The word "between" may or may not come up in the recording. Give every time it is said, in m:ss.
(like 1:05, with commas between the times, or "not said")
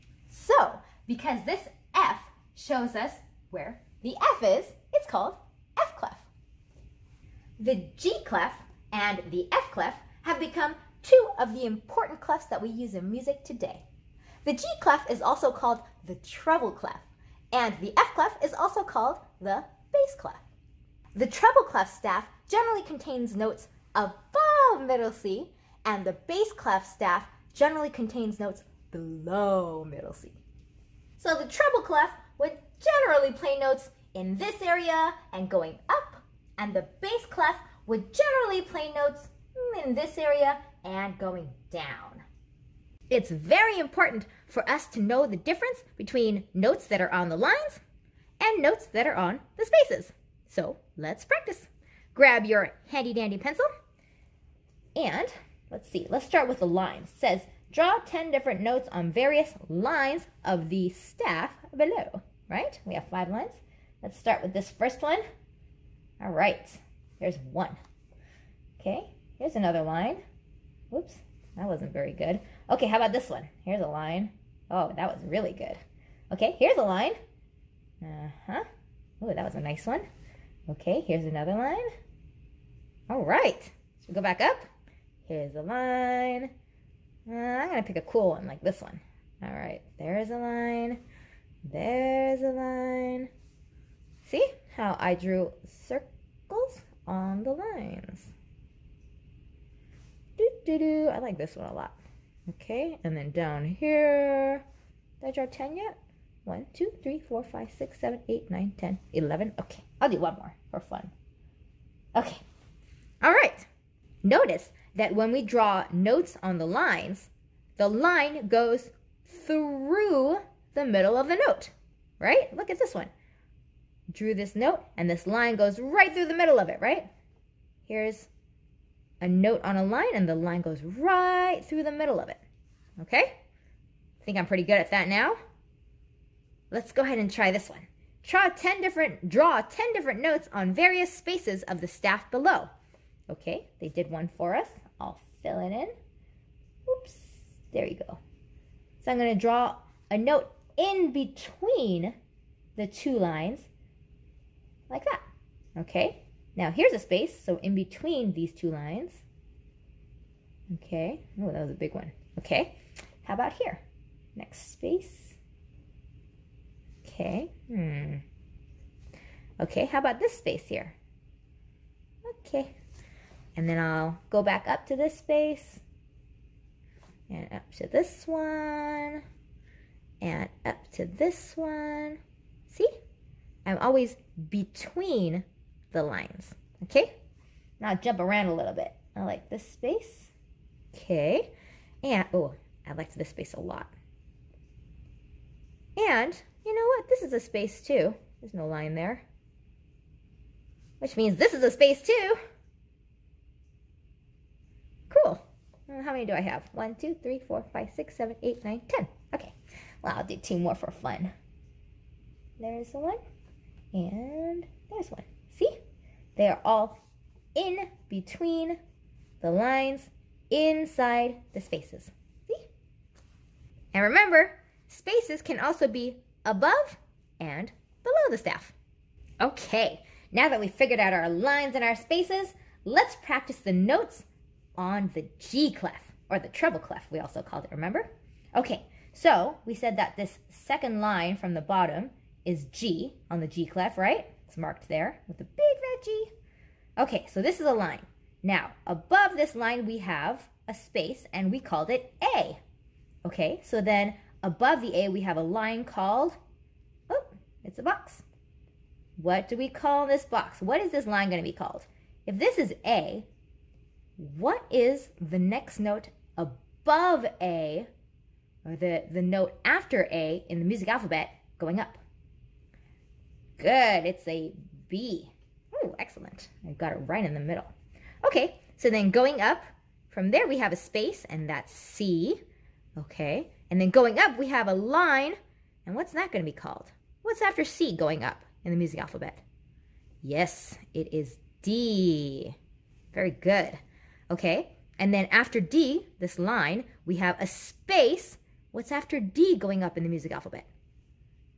0:45, 2:31, 2:37, 3:04, 3:38.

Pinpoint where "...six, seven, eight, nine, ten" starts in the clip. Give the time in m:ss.
3:27.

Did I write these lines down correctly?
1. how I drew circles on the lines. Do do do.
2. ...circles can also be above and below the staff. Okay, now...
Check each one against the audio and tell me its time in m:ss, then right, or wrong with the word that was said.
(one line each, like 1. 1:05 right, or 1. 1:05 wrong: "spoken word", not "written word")
1. 1:34 right
2. 3:44 wrong: "spaces", not "circles".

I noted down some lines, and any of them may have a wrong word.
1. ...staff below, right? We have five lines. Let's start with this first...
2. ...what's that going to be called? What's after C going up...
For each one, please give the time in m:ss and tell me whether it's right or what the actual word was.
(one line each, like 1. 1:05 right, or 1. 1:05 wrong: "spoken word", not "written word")
1. 1:00 right
2. 4:45 right.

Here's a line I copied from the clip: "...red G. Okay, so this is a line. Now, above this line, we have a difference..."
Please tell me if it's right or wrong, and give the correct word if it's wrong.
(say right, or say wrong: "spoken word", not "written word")
wrong: "space", not "difference".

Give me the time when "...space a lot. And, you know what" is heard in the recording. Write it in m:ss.
3:13.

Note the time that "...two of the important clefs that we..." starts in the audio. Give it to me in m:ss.
0:11.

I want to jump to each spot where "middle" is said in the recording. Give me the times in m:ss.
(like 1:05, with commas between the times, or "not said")
0:24, 0:29, 2:00, 2:06, 2:11, 4:37.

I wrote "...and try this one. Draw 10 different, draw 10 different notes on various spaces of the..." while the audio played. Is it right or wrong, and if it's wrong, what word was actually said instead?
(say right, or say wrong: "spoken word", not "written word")
right.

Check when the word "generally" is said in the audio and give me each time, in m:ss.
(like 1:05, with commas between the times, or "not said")
0:22, 0:27, 0:32, 0:38.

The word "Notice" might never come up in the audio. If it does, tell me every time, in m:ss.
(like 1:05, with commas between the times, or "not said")
1:54.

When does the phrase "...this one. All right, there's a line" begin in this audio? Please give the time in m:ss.
1:28.